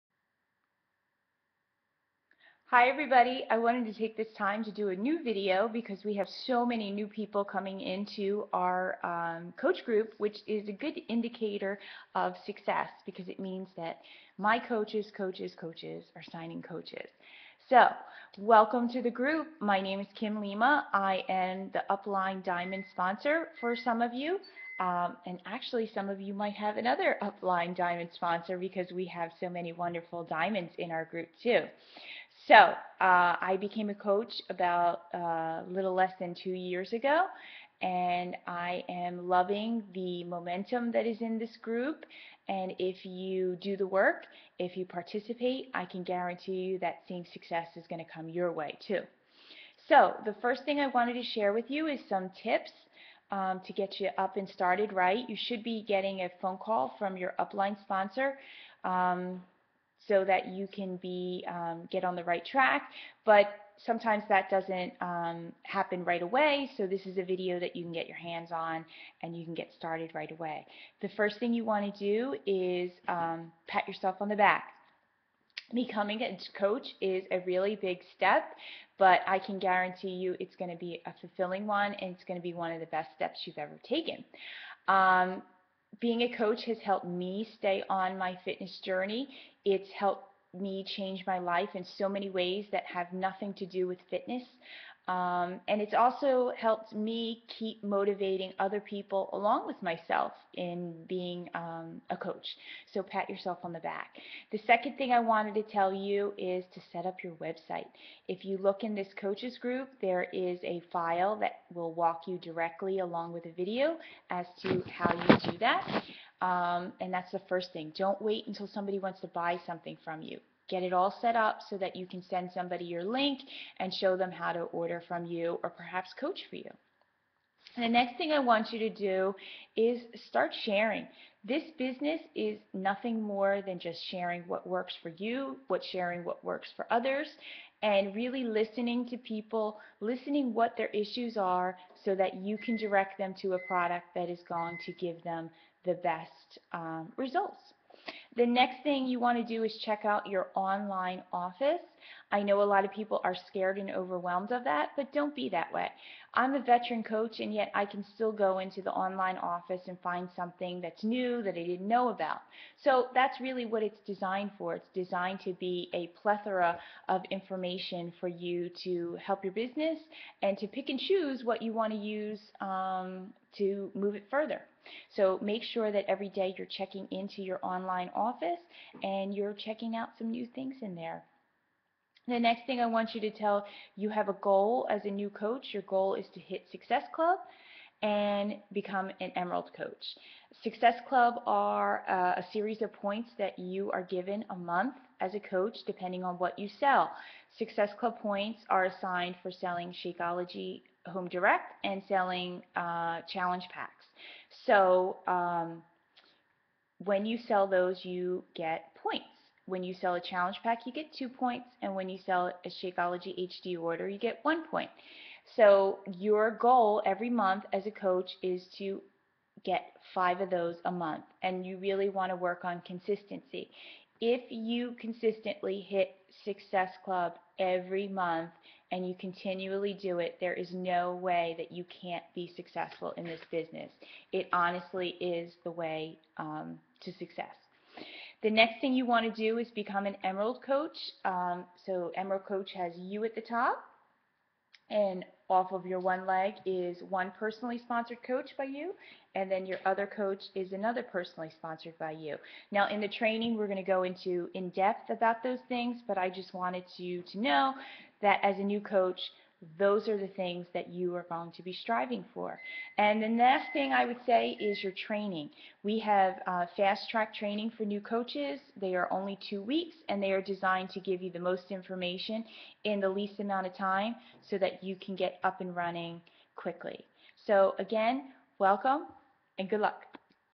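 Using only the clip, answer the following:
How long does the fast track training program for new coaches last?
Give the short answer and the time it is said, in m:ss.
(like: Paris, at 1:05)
2 weeks, at 4:29.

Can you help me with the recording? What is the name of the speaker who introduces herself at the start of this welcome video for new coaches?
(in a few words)
Kim Lima.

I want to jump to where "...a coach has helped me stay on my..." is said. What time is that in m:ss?
1:26.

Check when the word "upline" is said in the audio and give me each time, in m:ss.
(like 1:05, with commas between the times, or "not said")
0:21, 0:27, 0:57.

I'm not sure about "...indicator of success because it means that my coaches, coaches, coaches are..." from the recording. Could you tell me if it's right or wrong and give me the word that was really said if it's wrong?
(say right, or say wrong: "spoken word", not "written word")
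right.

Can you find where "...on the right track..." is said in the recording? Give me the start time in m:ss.
1:02.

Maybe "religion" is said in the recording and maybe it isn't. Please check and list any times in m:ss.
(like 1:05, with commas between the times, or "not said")
not said.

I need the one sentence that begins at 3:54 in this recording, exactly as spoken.
It honestly is the way um, to success.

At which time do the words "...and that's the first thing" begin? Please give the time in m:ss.
1:57.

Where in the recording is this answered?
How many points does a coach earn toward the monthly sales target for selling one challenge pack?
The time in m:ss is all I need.
3:31.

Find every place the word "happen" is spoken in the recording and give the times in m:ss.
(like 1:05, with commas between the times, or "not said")
1:05.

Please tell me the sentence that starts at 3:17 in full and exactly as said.
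Success Club points are assigned for selling Shakeology Home Direct and selling uh, challenge packs.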